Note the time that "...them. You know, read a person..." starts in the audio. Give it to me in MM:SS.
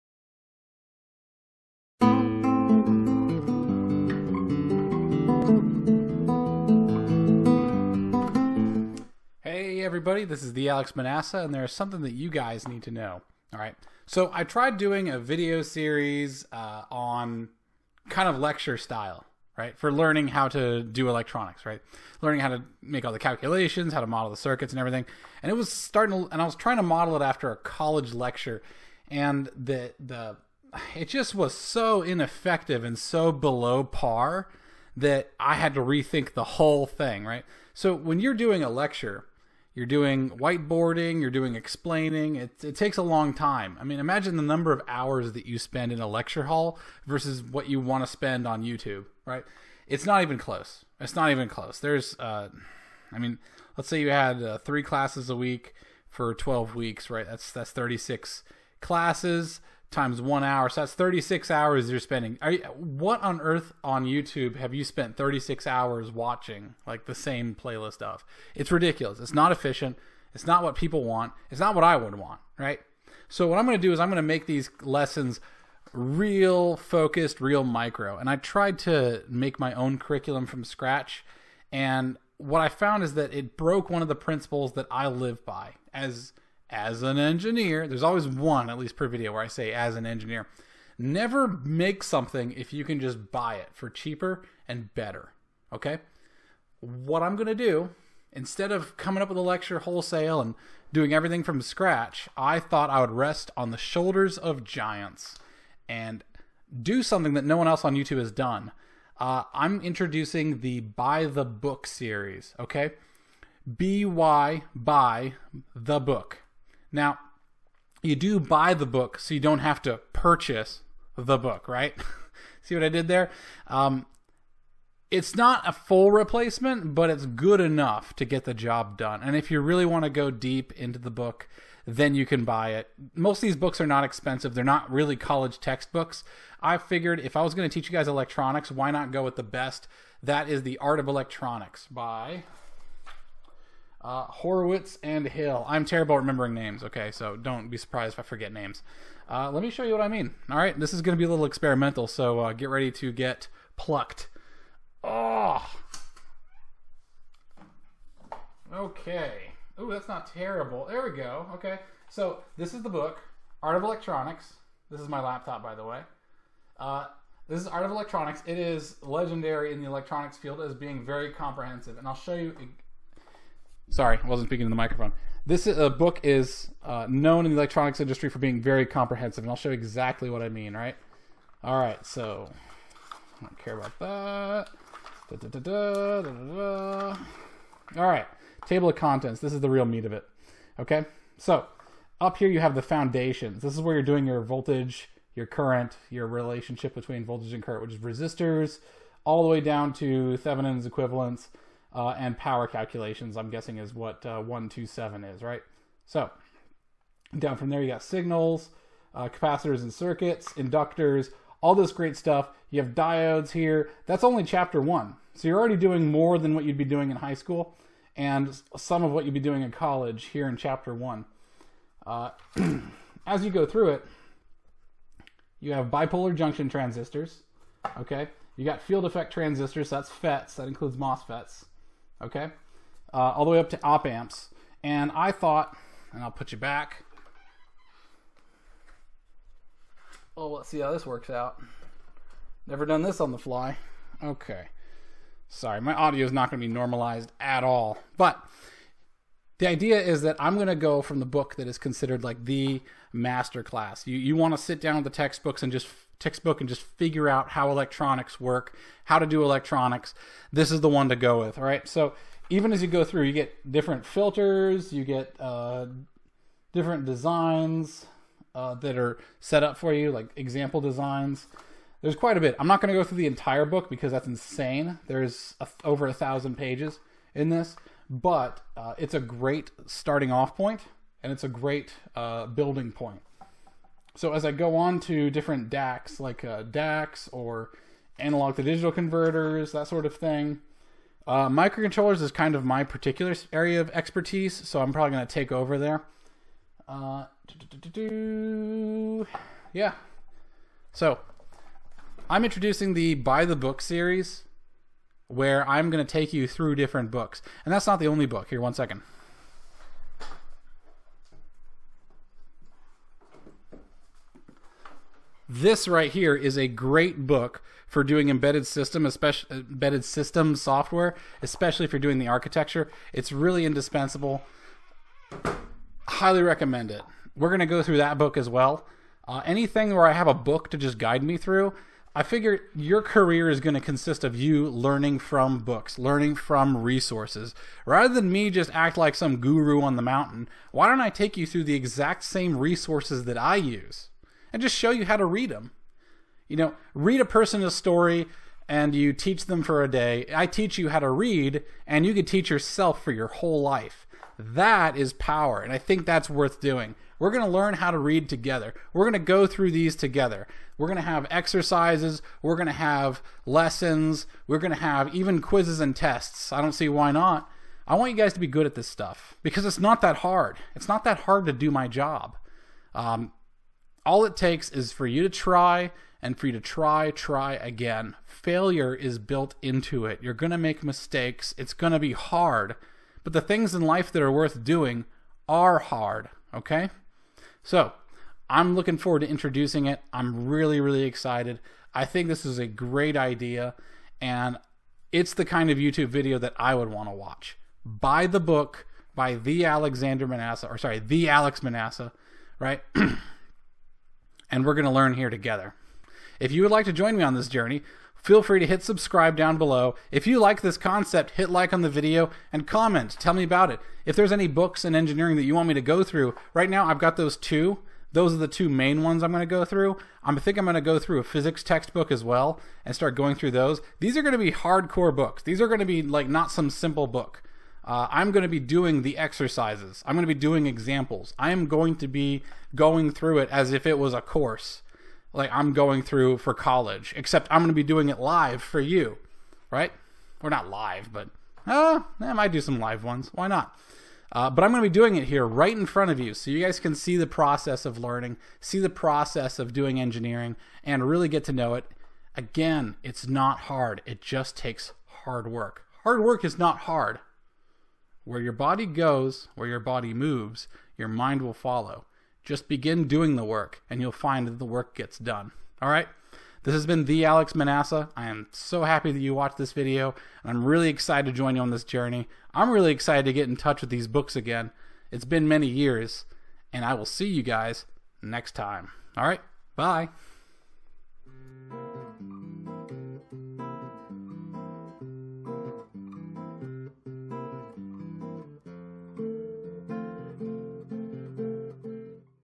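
05:45.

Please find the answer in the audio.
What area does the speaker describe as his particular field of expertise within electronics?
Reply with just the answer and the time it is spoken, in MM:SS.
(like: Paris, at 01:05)
microcontrollers, at 04:51.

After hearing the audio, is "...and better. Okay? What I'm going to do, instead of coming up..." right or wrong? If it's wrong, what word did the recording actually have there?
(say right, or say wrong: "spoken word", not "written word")
right.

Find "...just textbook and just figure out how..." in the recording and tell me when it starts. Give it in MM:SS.
04:15.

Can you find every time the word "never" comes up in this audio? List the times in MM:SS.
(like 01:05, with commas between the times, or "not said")
01:30, 04:02.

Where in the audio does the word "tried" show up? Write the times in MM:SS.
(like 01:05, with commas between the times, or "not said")
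00:14, 01:18.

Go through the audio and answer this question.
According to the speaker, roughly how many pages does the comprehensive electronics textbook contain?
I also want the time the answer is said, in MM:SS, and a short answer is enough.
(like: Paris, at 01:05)
over 1,000, at 04:35.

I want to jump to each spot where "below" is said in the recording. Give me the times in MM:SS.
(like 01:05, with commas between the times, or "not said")
00:33, 06:49.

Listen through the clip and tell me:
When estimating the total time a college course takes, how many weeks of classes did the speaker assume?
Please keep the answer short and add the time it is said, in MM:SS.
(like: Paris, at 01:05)
12, at 00:56.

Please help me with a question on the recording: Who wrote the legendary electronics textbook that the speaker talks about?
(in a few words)
Horowitz and Hill.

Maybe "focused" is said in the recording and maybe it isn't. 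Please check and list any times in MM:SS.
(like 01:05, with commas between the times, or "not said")
01:16.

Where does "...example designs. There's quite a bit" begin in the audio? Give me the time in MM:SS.
04:30.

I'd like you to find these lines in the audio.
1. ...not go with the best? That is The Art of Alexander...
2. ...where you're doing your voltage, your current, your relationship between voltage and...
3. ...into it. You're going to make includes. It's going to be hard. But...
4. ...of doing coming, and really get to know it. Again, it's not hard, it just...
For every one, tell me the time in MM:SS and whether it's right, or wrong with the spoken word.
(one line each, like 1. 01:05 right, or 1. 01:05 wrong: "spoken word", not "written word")
1. 02:18 wrong: "Electronics", not "Alexander"
2. 03:13 right
3. 06:19 wrong: "mistakes", not "includes"
4. 07:29 wrong: "engineering", not "coming".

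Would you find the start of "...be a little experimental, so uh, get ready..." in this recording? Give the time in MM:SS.
02:31.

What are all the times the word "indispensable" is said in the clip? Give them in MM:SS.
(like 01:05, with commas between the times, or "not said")
05:23.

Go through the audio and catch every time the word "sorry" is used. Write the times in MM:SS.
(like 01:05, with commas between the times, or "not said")
02:53, 04:05, 06:40.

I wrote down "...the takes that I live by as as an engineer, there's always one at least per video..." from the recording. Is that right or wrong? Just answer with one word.
wrong.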